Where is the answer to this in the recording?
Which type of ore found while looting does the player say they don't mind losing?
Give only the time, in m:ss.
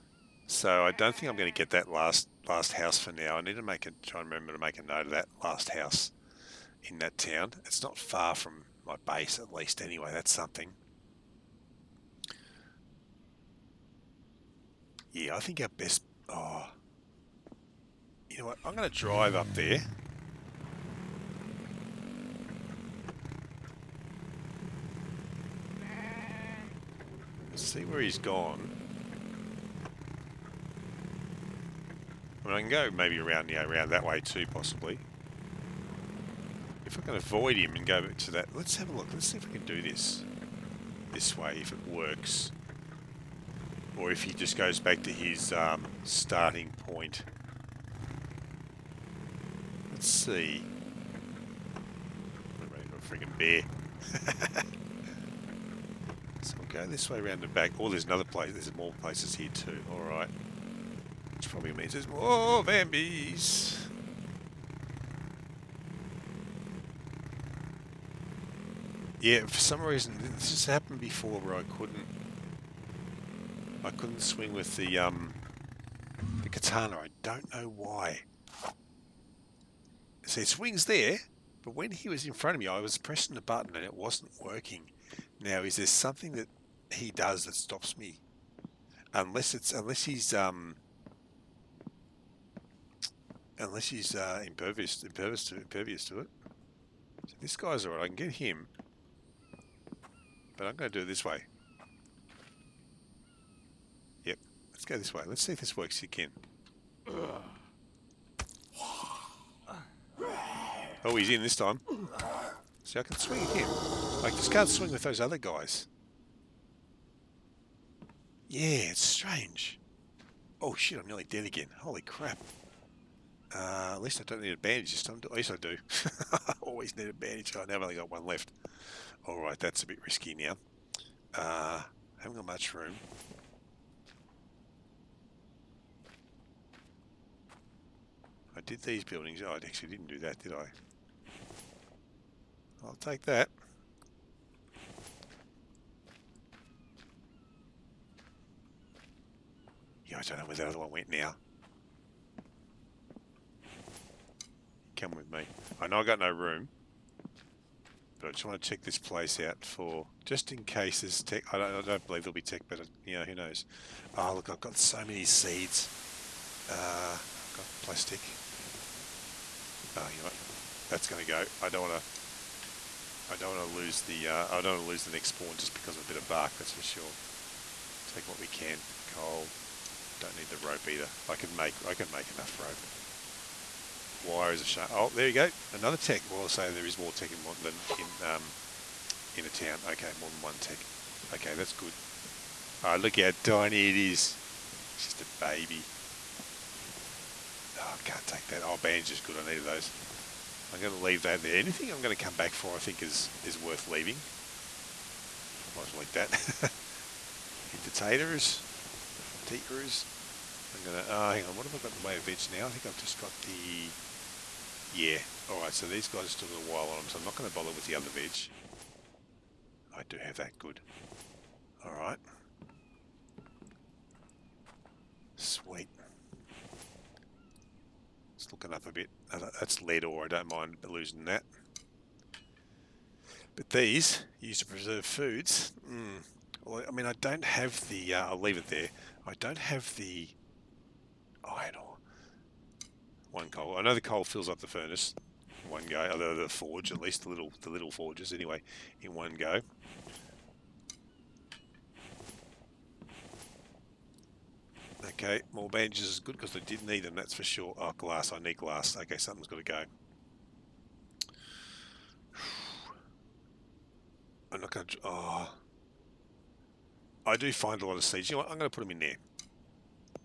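3:49.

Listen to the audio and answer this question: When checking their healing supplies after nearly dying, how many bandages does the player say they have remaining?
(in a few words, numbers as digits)
1.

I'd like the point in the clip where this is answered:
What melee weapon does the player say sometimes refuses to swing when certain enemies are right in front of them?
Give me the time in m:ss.
1:16.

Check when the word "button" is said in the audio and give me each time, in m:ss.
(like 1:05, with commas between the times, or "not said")
1:23.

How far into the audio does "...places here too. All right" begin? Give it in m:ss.
0:59.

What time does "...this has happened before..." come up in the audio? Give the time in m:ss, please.
1:10.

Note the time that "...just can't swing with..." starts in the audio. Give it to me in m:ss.
1:54.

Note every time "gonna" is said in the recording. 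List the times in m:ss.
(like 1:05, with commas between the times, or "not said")
2:51, 3:30.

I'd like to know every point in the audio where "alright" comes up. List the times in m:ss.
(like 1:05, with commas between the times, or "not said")
1:37, 3:35, 3:41.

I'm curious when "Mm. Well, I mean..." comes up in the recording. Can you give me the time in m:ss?
3:55.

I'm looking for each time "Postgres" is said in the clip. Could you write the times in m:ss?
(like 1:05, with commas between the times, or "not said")
not said.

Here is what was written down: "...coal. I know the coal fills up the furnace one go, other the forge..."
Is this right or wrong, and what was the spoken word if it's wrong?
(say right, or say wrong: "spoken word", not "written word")
right.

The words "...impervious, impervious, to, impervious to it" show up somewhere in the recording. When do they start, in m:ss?
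1:34.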